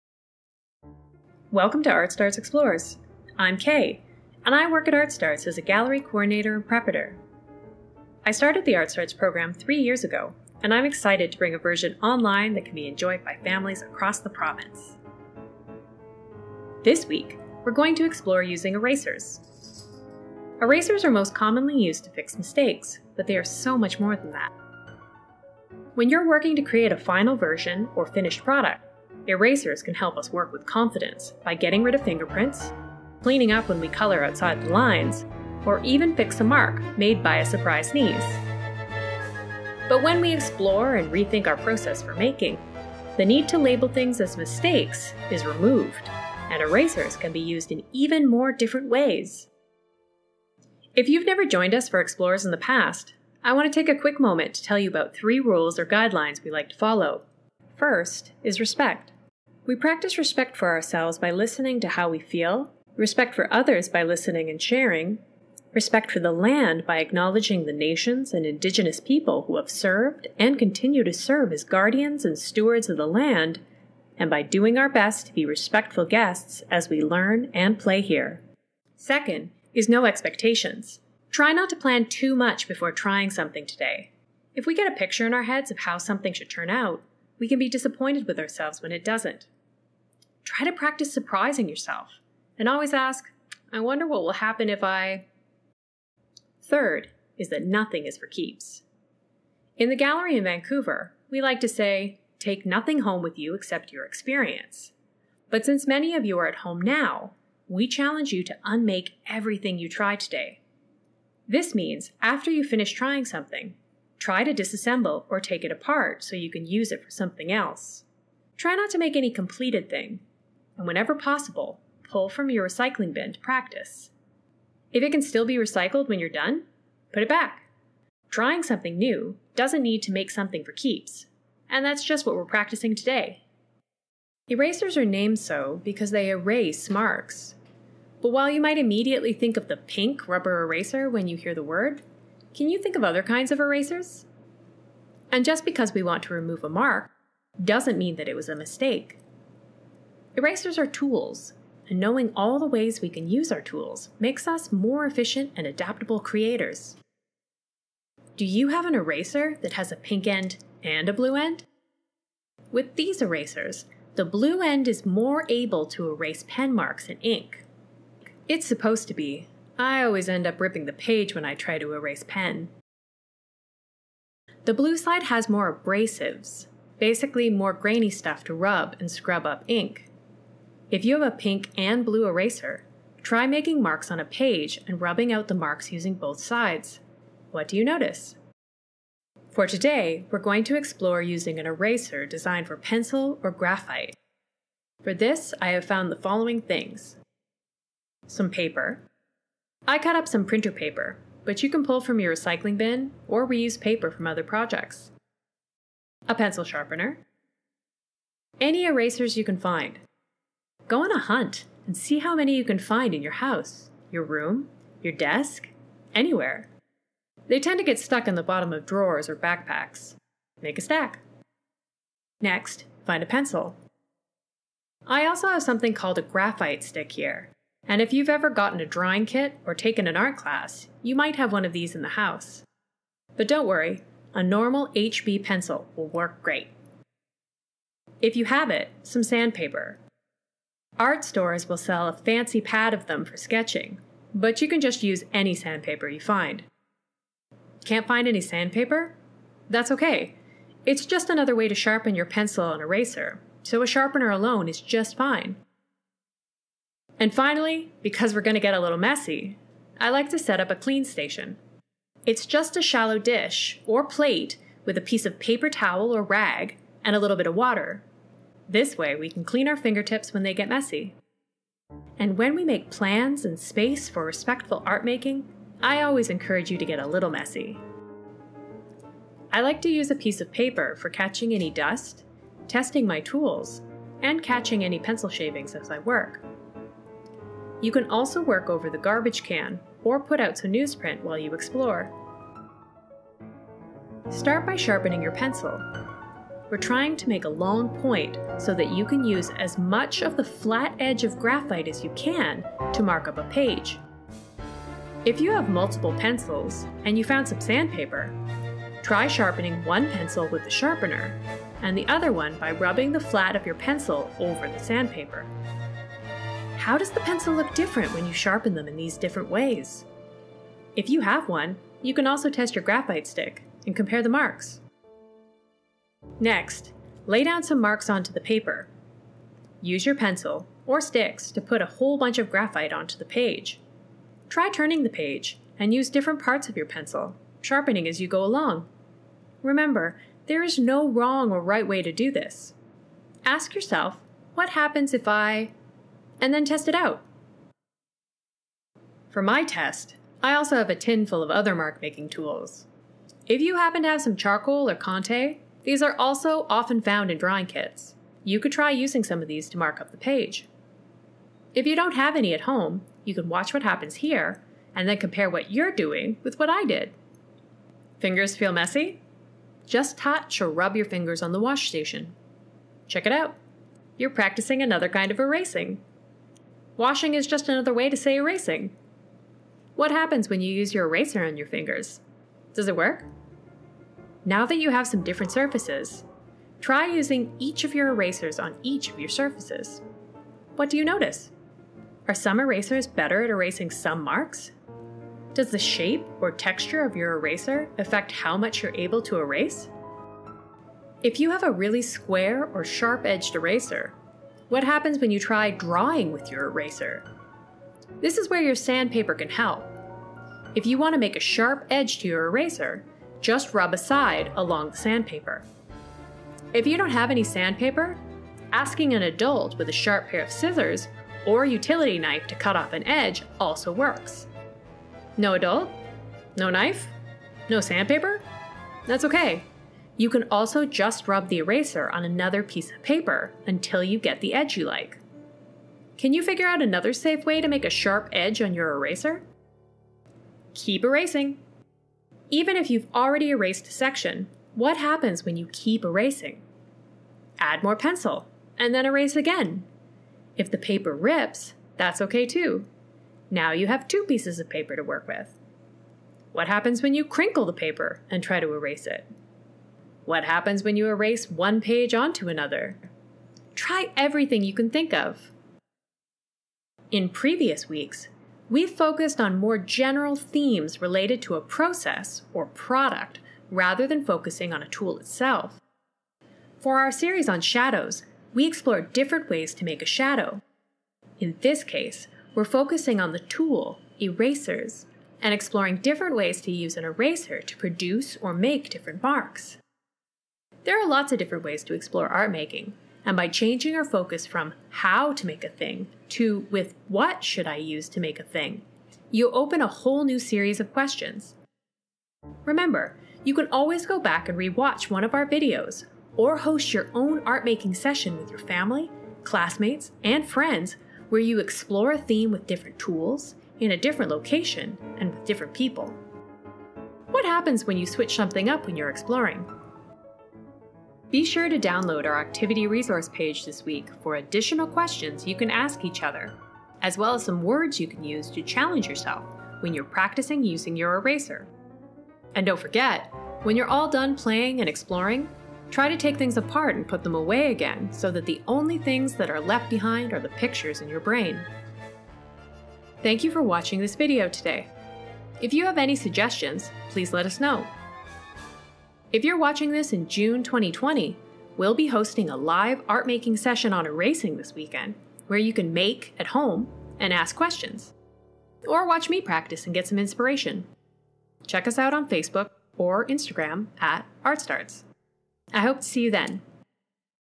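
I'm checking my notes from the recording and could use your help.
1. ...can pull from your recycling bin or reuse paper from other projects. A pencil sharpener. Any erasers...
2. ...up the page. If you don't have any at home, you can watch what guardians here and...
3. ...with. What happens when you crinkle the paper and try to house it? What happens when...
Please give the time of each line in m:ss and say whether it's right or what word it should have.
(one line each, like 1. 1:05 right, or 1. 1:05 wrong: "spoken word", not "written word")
1. 3:21 right
2. 6:00 wrong: "happens", not "guardians"
3. 7:35 wrong: "erase", not "house".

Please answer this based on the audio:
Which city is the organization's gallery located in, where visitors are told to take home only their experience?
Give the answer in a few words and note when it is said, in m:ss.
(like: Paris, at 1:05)
Vancouver, at 1:40.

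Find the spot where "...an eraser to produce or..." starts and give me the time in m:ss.
8:06.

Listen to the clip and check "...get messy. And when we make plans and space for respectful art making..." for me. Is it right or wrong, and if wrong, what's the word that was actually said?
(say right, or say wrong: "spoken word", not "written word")
right.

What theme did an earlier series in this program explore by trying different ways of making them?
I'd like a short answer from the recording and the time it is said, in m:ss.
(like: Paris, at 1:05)
Shadows, at 7:57.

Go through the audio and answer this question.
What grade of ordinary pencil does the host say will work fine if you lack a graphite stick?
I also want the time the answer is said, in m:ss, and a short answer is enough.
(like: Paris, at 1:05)
HB, at 3:54.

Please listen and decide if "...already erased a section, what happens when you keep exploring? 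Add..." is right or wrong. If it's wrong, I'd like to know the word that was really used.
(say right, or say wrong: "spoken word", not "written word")
wrong: "erasing", not "exploring".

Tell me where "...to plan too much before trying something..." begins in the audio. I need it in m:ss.
1:21.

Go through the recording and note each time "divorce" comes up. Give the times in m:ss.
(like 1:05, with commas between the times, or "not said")
not said.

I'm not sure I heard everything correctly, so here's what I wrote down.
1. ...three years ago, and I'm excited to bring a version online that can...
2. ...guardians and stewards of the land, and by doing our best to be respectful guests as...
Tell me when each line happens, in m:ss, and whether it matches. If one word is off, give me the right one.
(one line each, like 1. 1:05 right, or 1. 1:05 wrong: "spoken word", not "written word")
1. 0:09 right
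2. 1:11 right.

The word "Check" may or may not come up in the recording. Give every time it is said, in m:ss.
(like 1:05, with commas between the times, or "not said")
6:13, 9:21.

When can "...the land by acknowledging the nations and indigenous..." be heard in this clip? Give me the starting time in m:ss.
1:06.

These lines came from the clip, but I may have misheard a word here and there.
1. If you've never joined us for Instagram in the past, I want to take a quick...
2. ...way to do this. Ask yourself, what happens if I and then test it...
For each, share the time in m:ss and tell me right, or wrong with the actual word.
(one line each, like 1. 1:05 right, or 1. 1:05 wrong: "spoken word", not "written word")
1. 0:50 wrong: "Explores", not "Instagram"
2. 5:41 right.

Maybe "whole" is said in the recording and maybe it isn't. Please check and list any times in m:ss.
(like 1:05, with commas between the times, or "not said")
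5:31, 8:19.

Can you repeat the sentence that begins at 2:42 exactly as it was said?
With these erasers, the blue end is more able to erase pen marks and ink.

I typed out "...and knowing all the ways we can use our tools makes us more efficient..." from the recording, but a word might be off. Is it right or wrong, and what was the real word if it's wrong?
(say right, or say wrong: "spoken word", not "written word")
right.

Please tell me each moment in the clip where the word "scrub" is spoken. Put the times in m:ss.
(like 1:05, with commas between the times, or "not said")
2:59.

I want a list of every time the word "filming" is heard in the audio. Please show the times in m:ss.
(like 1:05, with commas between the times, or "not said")
not said.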